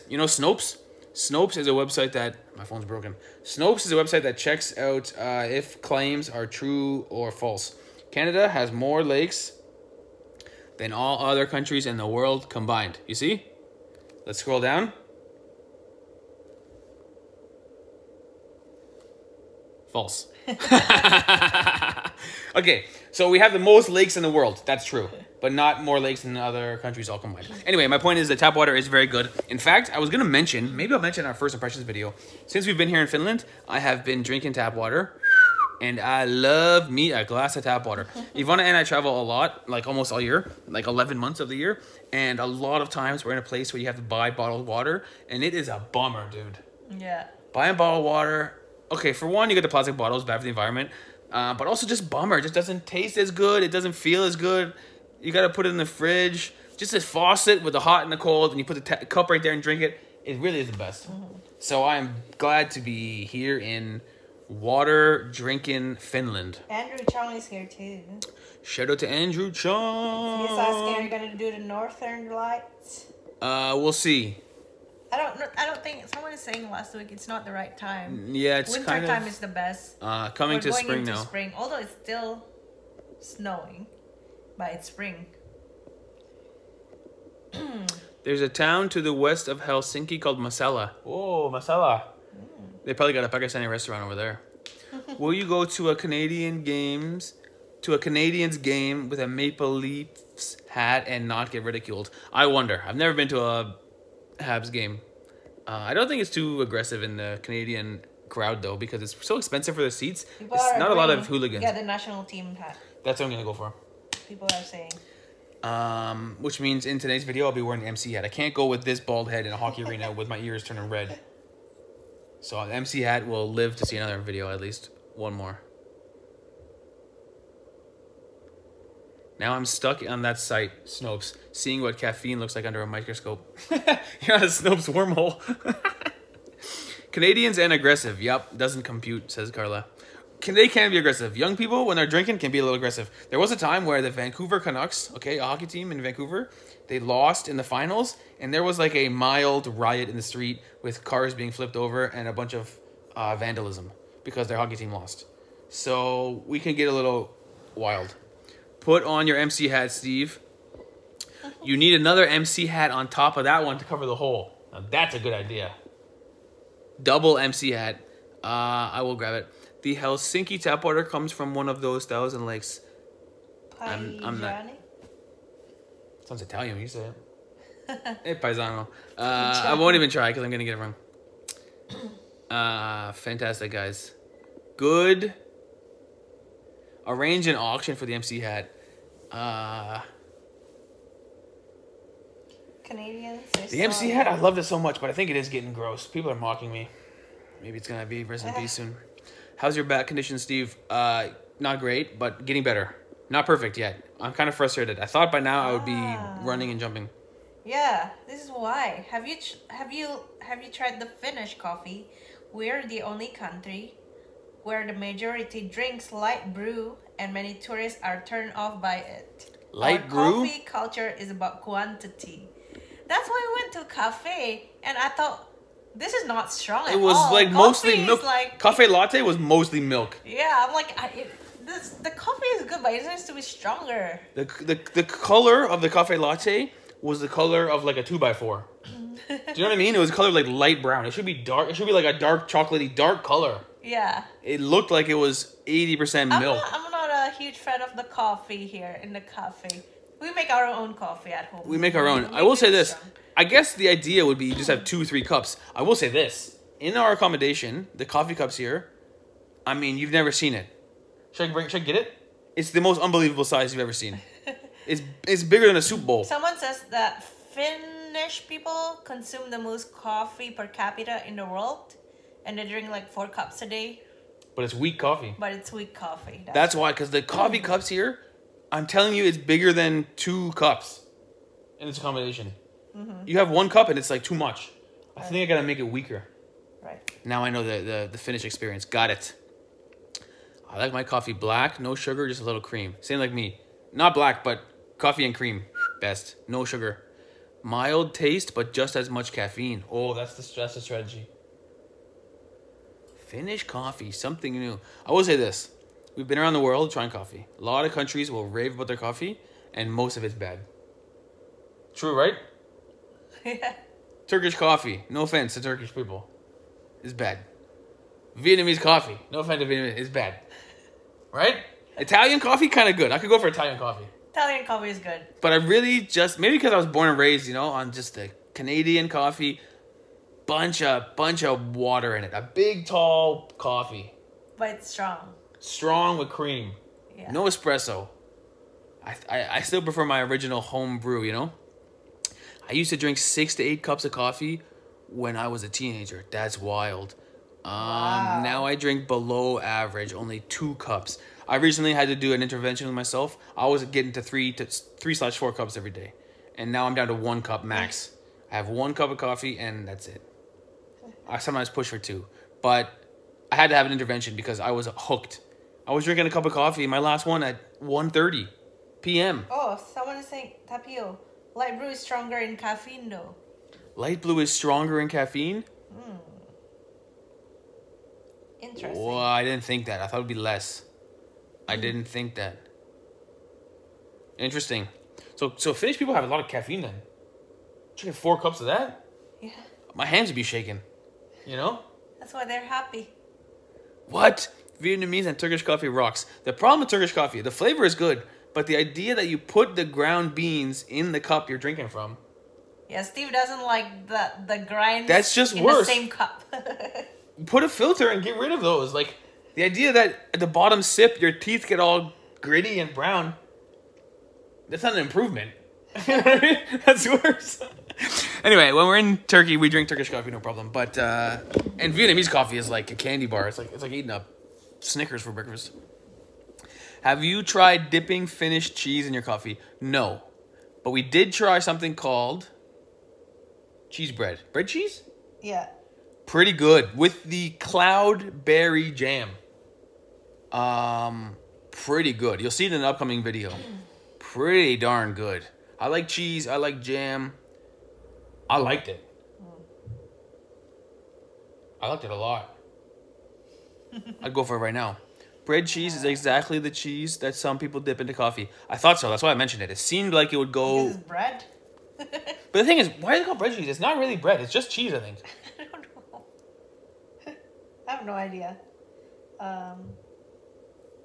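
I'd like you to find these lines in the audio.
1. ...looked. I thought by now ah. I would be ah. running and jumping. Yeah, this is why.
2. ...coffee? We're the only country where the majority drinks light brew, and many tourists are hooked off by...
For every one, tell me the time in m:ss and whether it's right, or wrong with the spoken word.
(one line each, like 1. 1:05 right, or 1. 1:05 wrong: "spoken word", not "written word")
1. 3:24 wrong: "frustrated", not "looked"
2. 3:31 wrong: "turned", not "hooked".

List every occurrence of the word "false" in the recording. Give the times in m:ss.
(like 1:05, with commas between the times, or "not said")
0:07, 0:19.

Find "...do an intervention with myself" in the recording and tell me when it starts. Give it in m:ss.
5:52.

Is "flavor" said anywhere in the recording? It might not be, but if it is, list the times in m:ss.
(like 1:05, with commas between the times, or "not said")
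6:37.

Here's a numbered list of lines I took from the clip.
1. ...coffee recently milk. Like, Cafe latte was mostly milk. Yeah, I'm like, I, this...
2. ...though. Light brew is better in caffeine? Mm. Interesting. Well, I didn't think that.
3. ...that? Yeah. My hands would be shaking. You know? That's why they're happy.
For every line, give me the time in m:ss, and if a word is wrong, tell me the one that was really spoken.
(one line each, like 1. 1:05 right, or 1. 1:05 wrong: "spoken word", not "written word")
1. 3:47 wrong: "mostly", not "recently"
2. 6:13 wrong: "stronger", not "better"
3. 6:28 right.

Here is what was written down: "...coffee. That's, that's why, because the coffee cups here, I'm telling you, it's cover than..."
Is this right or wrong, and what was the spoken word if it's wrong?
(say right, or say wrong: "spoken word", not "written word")
wrong: "bigger", not "cover".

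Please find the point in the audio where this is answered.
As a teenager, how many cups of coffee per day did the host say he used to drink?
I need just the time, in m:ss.
5:43.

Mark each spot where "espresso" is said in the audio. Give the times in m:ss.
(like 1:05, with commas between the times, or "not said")
5:37.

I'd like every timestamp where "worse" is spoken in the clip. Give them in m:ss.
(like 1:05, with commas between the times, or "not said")
6:45, 6:57.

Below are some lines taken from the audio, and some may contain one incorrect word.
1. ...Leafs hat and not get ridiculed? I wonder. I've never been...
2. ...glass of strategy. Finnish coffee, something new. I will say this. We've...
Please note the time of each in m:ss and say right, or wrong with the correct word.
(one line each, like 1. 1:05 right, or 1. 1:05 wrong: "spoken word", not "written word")
1. 1:39 right
2. 5:00 wrong: "stress", not "glass".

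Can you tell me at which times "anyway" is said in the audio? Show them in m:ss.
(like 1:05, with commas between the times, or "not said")
0:27, 6:58.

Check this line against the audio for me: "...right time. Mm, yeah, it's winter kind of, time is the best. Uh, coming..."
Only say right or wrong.
right.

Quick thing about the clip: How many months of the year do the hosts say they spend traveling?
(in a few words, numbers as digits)
11.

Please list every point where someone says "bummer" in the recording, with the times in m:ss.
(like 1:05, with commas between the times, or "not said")
0:45, 0:52.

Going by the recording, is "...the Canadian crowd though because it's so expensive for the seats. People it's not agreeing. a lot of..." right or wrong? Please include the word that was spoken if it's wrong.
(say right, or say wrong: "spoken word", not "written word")
right.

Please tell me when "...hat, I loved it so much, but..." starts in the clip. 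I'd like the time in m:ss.
3:14.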